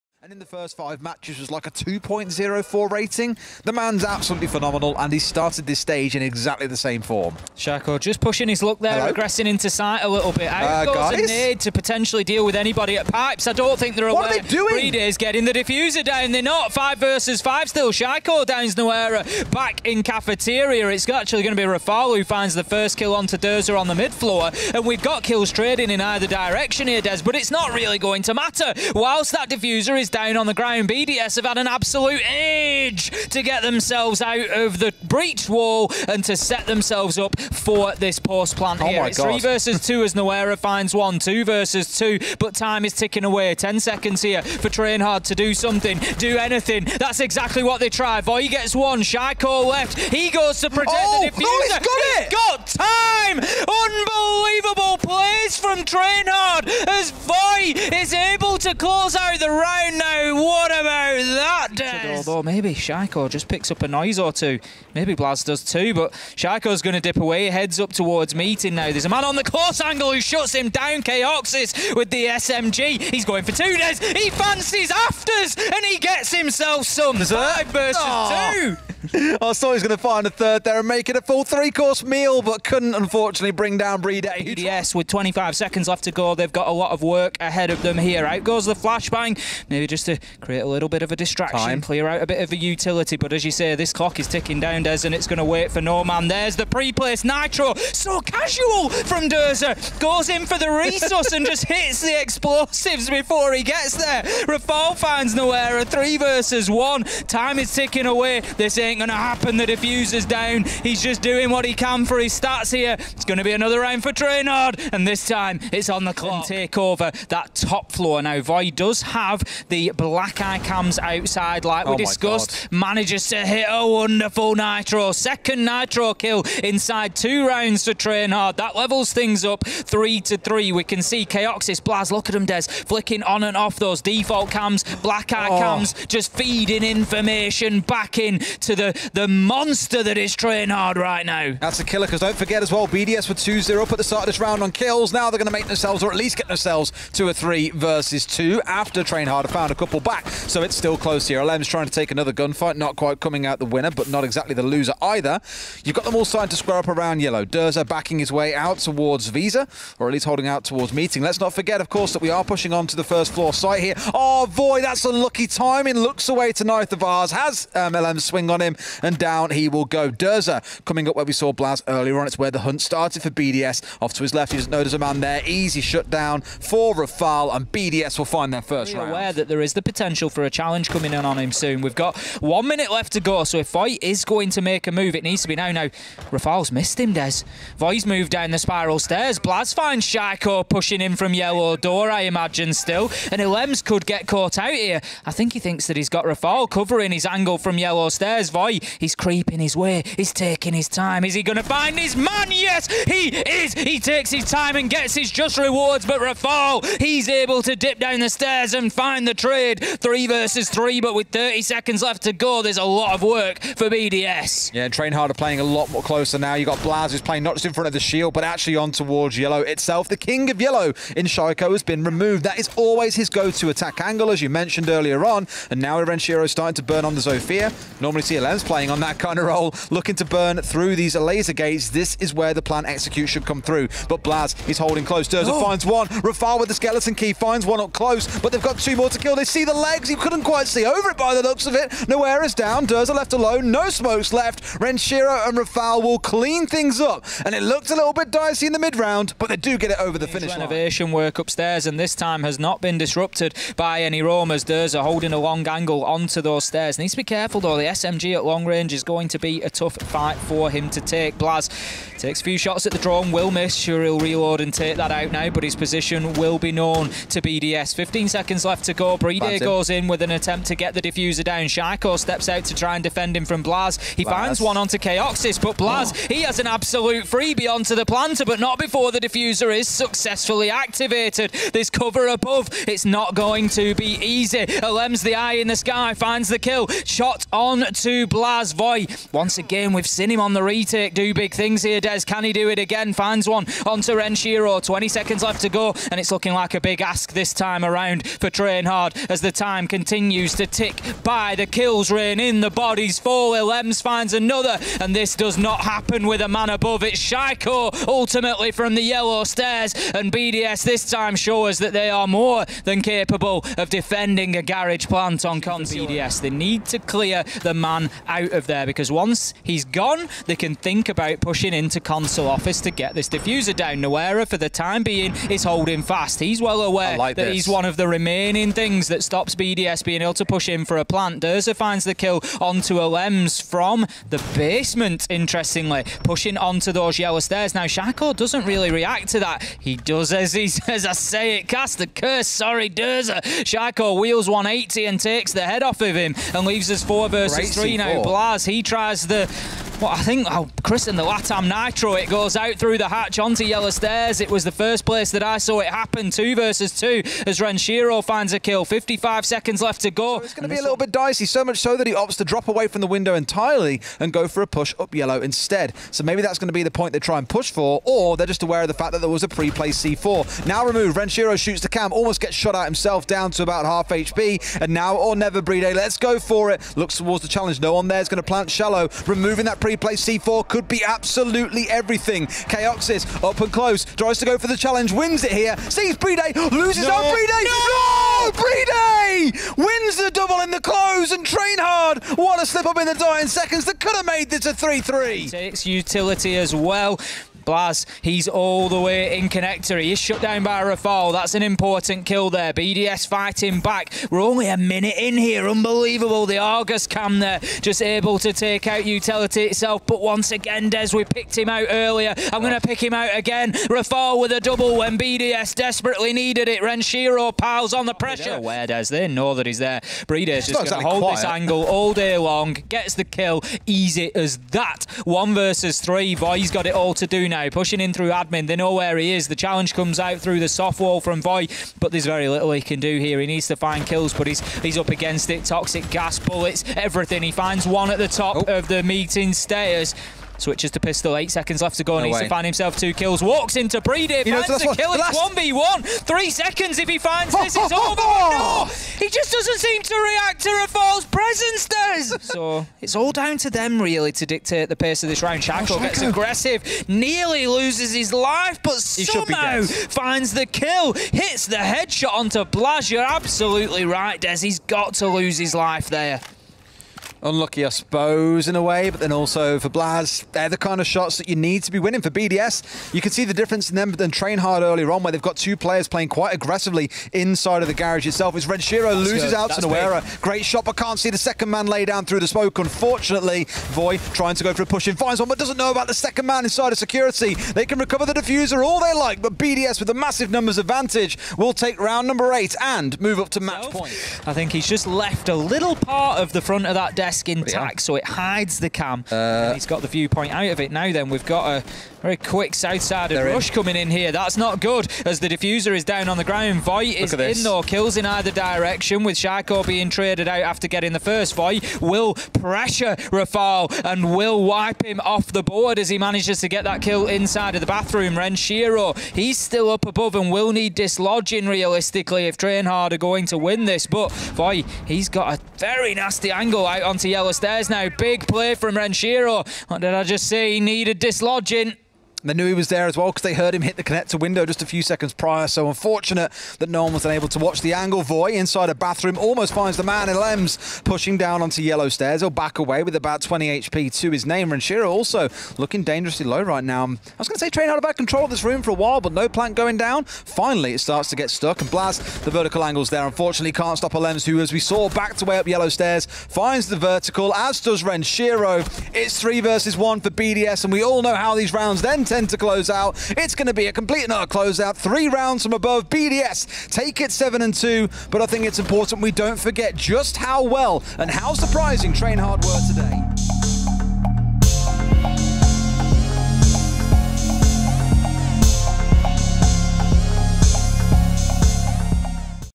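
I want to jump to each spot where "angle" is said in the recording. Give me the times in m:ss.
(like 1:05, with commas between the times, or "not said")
1:09, 3:17, 3:44, 4:15, 7:01, 8:46, 8:57, 9:12.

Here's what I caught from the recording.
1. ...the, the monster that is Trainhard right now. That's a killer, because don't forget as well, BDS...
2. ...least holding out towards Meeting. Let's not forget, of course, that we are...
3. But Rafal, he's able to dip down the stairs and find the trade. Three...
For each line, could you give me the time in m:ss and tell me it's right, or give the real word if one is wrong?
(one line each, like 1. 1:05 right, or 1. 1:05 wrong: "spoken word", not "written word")
1. 2:18 right
2. 2:40 right
3. 3:26 right.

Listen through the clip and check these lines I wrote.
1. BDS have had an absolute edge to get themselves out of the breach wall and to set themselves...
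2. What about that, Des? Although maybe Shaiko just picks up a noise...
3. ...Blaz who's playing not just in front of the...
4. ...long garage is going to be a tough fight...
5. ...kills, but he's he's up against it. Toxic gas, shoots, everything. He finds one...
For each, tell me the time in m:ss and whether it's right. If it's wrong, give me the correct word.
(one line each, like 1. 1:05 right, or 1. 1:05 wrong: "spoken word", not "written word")
1. 0:30 right
2. 1:00 right
3. 3:36 right
4. 4:18 wrong: "range", not "garage"
5. 7:14 wrong: "bullets", not "shoots".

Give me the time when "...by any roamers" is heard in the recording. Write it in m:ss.
4:13.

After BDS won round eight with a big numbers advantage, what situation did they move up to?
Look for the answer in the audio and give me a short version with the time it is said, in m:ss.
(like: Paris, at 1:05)
Match point, at 8:13.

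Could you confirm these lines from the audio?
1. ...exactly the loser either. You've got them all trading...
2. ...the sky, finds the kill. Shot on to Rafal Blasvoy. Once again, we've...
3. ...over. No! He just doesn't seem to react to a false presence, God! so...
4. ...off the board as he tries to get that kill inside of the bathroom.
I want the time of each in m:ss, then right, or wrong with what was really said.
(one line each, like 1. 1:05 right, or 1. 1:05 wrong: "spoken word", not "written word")
1. 2:34 wrong: "starting", not "trading"
2. 4:45 wrong: "Blaz", not "Rafal"
3. 7:27 wrong: "Des", not "God"
4. 8:35 wrong: "manages", not "tries".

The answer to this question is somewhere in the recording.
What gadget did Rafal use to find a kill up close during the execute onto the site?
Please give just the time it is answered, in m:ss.
3:56.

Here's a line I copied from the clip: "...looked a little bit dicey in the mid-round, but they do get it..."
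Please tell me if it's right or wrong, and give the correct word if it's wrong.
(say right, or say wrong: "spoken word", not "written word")
right.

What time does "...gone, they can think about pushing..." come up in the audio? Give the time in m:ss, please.
5:19.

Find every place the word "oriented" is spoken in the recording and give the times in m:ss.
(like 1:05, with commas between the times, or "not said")
not said.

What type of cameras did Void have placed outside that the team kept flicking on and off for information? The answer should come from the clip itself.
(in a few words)
Black eye cams.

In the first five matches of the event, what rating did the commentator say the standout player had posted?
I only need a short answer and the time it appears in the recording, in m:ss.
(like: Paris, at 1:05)
2.04, at 0:01.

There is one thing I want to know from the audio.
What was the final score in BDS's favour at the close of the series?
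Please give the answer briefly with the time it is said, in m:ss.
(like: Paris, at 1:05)
7-2, at 9:27.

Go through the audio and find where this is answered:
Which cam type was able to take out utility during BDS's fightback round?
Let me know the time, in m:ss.
6:46.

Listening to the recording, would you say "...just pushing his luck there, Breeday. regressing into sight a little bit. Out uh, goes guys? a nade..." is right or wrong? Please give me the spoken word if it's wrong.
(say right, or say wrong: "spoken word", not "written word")
wrong: "Hello", not "Breeday".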